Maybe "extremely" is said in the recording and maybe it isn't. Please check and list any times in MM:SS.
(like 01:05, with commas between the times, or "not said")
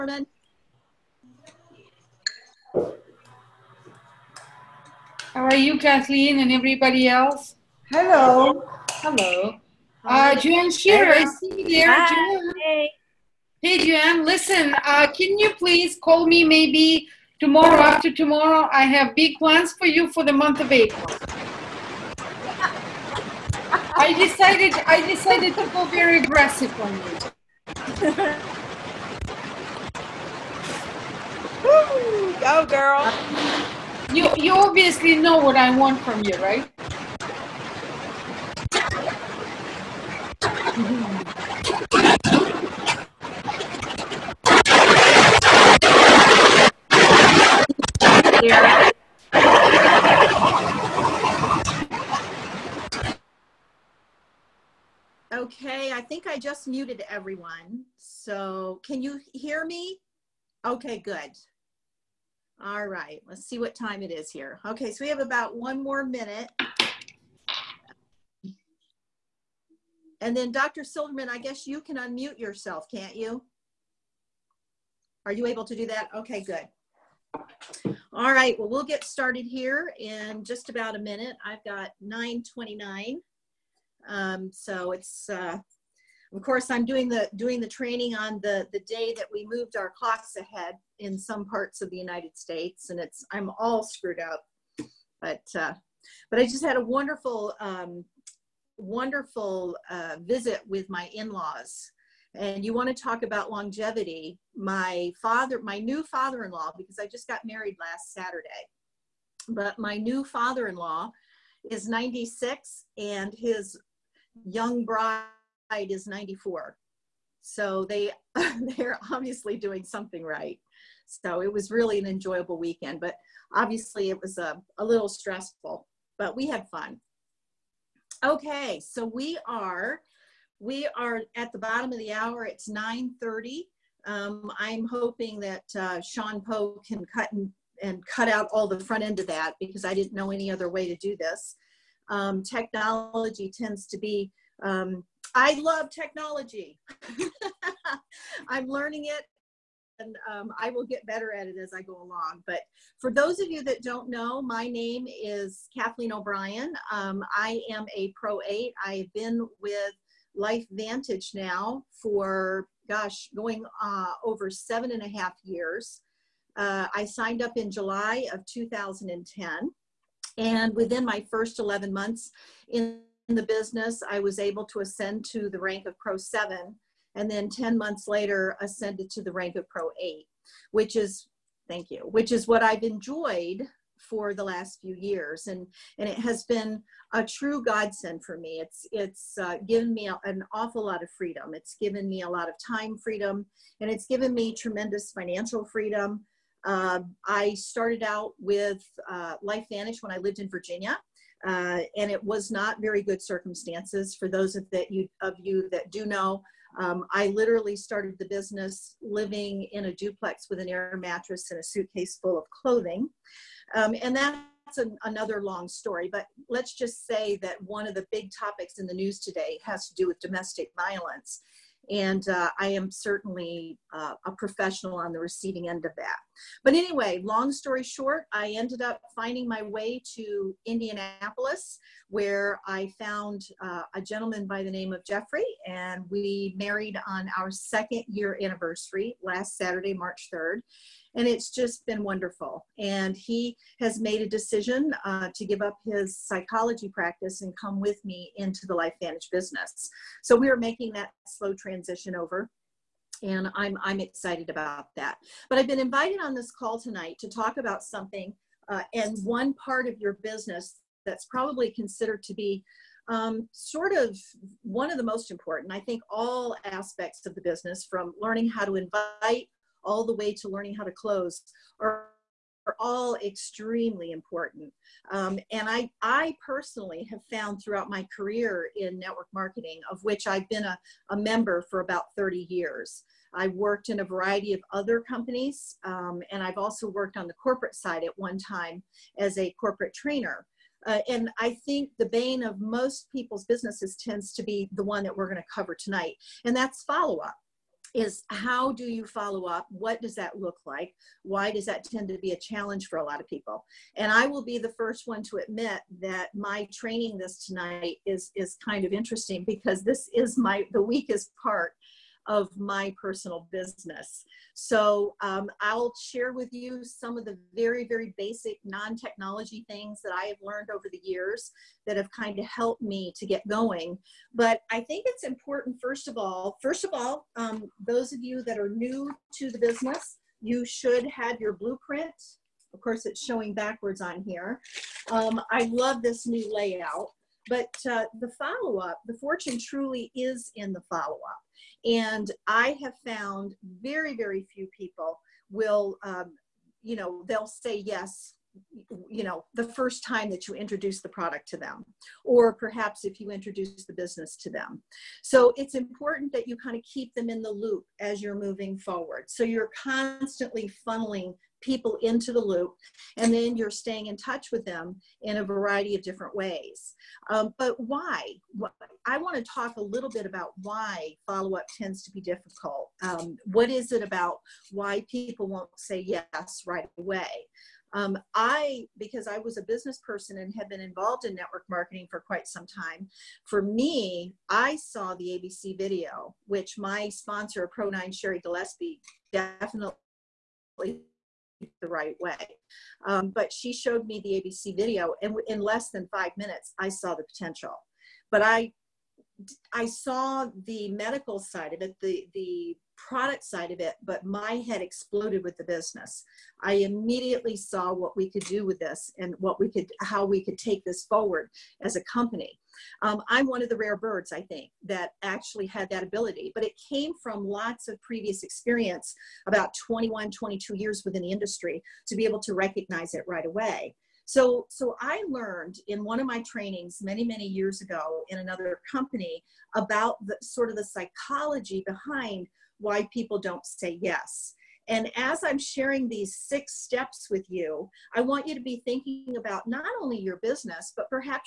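04:33.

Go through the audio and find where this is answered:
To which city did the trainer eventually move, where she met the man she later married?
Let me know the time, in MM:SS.
03:50.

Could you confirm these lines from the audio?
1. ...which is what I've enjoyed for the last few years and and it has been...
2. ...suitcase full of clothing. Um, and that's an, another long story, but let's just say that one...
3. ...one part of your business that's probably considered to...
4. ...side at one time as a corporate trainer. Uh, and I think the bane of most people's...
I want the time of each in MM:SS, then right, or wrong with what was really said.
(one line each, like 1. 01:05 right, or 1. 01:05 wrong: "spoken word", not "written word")
1. 03:01 right
2. 03:31 right
3. 04:19 right
4. 04:47 right.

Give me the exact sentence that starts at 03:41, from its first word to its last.
And uh, I am certainly uh, a professional on the receiving end of that.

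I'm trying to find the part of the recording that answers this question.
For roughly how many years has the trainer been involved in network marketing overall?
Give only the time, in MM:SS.
04:41.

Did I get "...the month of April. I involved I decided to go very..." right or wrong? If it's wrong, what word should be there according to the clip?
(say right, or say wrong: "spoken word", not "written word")
wrong: "decided", not "involved".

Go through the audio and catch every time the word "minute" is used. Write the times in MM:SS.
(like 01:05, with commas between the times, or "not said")
01:06, 01:20, 06:36.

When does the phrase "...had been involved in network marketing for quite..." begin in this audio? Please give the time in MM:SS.
06:20.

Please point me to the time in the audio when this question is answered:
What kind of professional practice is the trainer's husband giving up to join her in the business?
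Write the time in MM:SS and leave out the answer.
04:06.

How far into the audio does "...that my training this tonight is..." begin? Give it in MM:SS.
05:06.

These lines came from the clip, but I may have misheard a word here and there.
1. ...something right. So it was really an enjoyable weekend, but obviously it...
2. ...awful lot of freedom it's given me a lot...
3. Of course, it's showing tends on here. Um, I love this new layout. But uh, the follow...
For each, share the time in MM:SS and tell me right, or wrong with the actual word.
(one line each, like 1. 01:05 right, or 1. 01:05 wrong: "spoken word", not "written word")
1. 01:59 right
2. 03:10 right
3. 05:32 wrong: "backwards", not "tends".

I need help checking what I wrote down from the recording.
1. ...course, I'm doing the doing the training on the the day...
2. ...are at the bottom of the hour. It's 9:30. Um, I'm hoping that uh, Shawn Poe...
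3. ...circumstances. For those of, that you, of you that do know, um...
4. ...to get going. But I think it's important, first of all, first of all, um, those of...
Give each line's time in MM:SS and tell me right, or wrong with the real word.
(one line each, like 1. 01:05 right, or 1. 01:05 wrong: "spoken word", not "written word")
1. 01:26 right
2. 02:10 right
3. 03:23 right
4. 05:23 right.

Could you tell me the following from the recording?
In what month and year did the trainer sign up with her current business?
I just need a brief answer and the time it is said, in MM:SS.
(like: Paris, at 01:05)
July 2010, at 02:47.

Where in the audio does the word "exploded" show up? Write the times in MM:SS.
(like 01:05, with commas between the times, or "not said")
06:44.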